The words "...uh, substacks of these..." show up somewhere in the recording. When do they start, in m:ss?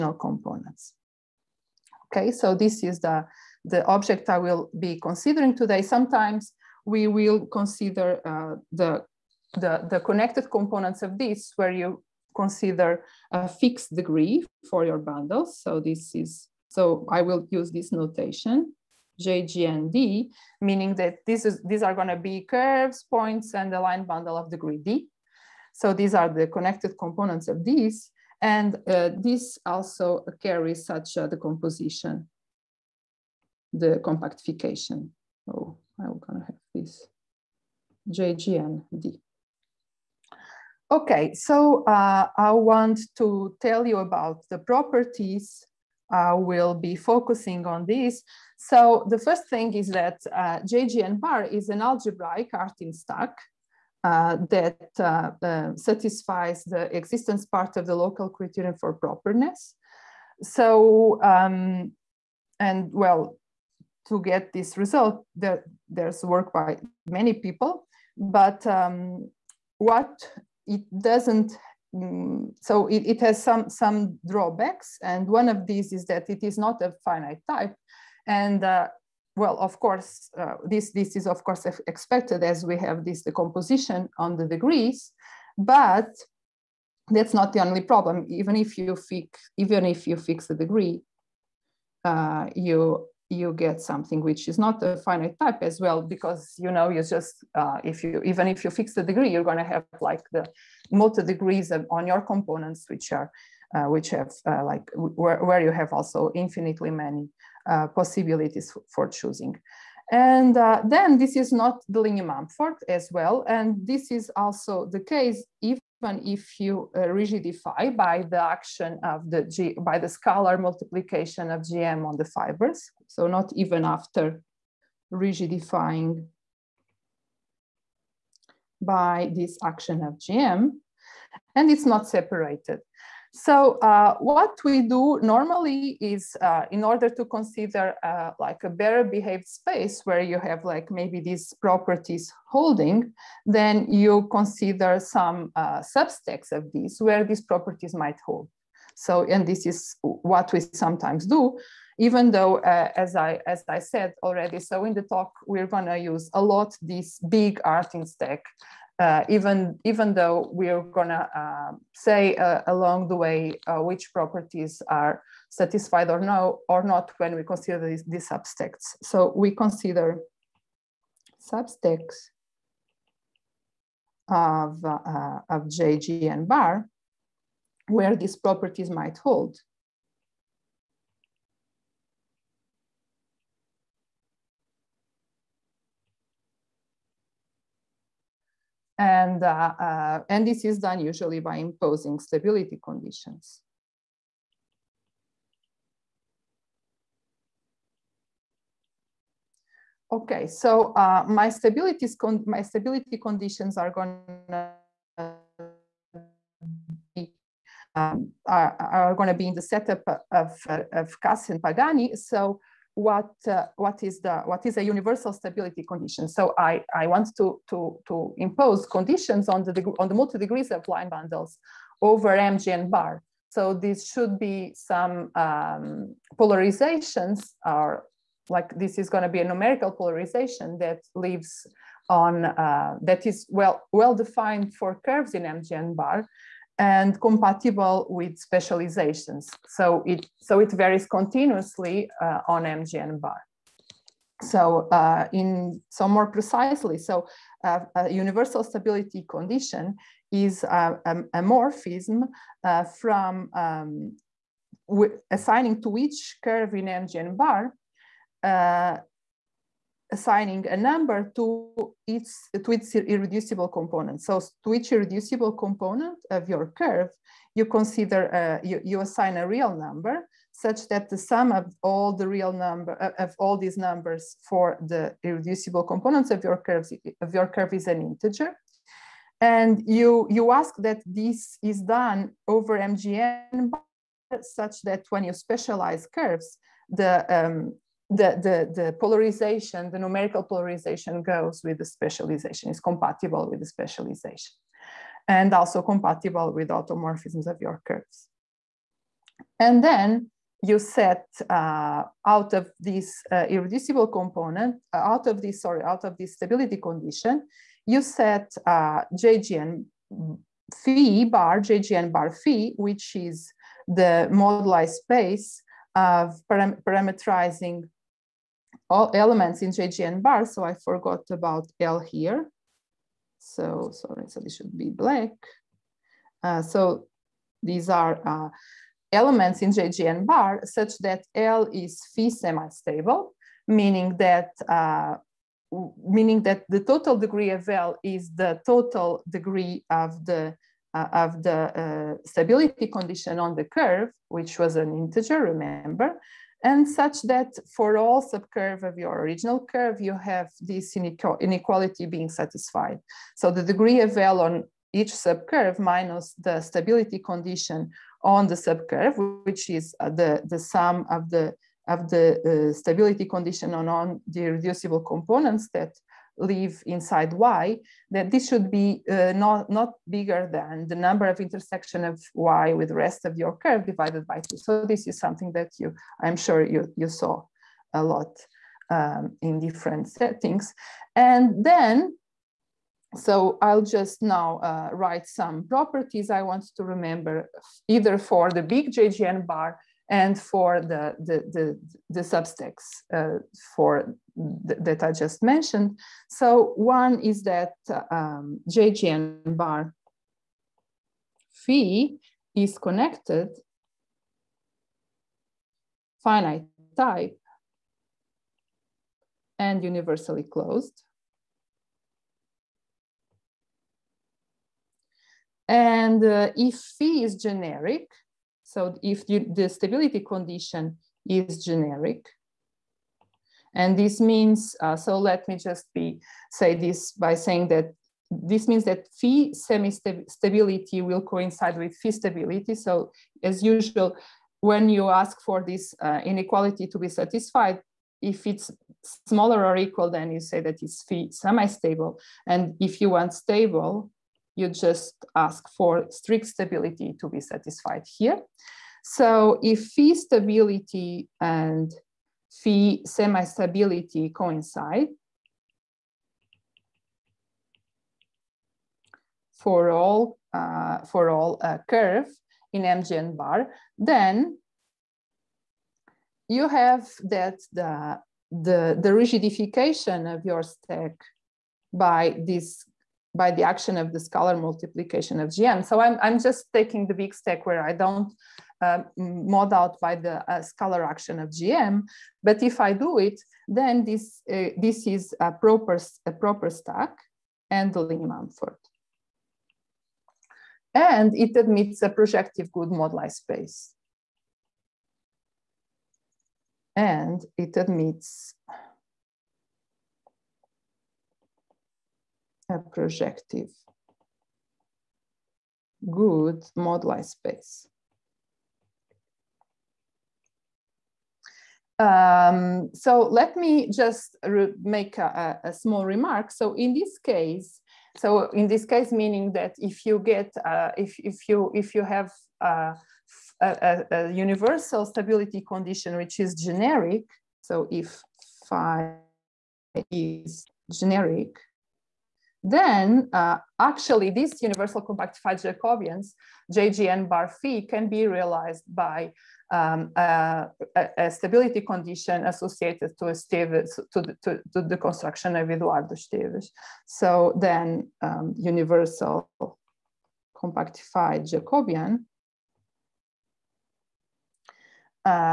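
2:25.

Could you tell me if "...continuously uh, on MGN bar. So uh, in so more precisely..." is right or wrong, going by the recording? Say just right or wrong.
right.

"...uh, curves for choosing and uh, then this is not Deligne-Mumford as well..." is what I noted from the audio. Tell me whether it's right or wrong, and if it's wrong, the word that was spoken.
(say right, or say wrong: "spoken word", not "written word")
wrong: "possibilities", not "curves".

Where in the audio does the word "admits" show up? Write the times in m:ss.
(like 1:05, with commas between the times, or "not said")
8:11, 8:17.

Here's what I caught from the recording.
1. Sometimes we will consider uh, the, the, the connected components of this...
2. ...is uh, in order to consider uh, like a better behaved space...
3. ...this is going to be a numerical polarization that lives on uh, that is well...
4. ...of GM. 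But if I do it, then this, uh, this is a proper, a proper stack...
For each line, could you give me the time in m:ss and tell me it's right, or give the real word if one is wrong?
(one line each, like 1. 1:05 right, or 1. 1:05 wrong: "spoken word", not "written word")
1. 0:05 right
2. 2:15 right
3. 3:48 right
4. 8:01 right.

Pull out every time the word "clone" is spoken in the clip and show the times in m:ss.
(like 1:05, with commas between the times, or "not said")
not said.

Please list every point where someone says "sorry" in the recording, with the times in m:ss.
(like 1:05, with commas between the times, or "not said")
5:05, 5:23.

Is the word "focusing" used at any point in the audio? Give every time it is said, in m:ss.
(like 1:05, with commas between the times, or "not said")
0:46.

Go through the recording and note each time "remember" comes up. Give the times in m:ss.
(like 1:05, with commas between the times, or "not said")
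5:45, 6:26.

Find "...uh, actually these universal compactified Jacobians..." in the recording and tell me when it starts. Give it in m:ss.
8:53.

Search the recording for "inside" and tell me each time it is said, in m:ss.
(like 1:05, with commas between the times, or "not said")
6:06.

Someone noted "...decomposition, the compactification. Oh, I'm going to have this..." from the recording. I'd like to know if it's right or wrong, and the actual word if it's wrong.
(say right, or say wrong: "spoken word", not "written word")
right.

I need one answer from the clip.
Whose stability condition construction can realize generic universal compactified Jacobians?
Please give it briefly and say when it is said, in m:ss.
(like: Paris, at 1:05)
Eduardo Esteves, at 9:05.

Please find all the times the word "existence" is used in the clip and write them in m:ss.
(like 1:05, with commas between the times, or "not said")
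0:56.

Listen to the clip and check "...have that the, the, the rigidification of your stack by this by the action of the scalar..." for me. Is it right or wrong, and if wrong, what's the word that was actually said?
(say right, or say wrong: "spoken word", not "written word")
right.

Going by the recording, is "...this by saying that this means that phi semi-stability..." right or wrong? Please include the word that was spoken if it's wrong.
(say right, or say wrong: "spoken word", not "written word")
right.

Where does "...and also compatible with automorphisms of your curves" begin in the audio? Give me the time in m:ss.
4:55.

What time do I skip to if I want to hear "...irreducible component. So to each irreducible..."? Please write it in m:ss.
4:22.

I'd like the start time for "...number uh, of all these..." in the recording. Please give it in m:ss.
4:32.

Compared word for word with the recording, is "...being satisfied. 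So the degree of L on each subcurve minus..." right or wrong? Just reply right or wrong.
right.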